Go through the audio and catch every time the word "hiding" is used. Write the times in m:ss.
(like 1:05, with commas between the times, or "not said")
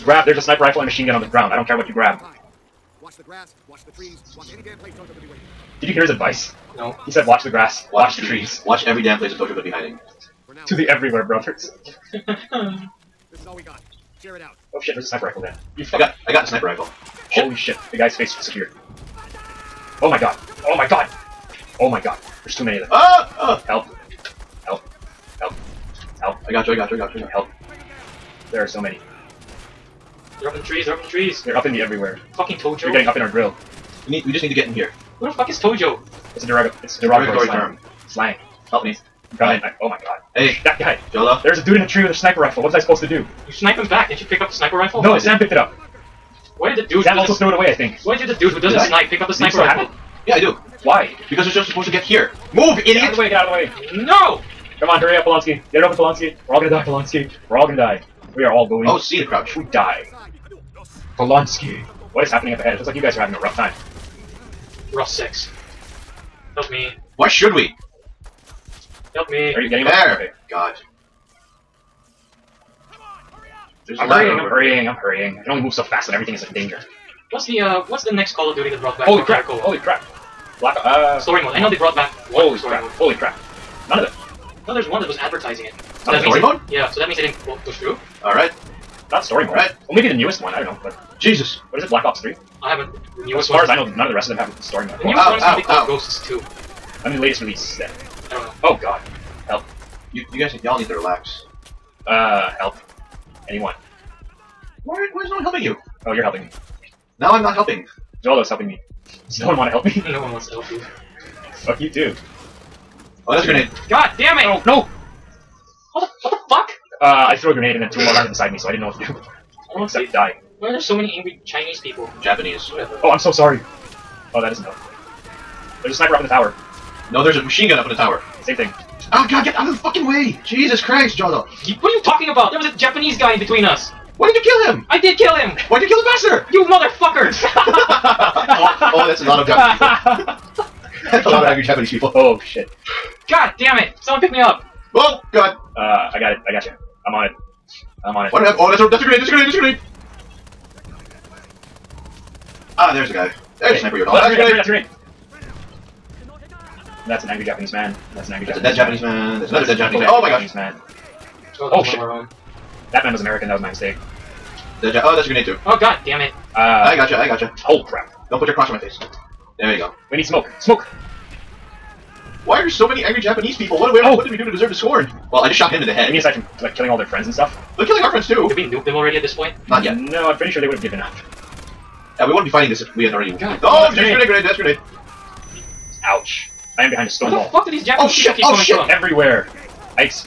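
0:09.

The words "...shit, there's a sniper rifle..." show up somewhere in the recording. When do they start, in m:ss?
0:14.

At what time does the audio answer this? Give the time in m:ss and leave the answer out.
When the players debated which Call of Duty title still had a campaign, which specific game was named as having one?
1:31.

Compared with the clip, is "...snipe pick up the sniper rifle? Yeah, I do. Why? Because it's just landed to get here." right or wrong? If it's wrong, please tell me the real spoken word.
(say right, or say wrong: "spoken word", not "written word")
wrong: "supposed", not "landed".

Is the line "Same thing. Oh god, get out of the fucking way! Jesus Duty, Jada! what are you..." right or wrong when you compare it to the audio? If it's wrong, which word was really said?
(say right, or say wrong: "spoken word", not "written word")
wrong: "Christ", not "Duty".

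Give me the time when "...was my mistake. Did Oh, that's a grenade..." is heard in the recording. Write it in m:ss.
2:43.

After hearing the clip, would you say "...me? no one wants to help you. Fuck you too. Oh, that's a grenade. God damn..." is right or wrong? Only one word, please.
right.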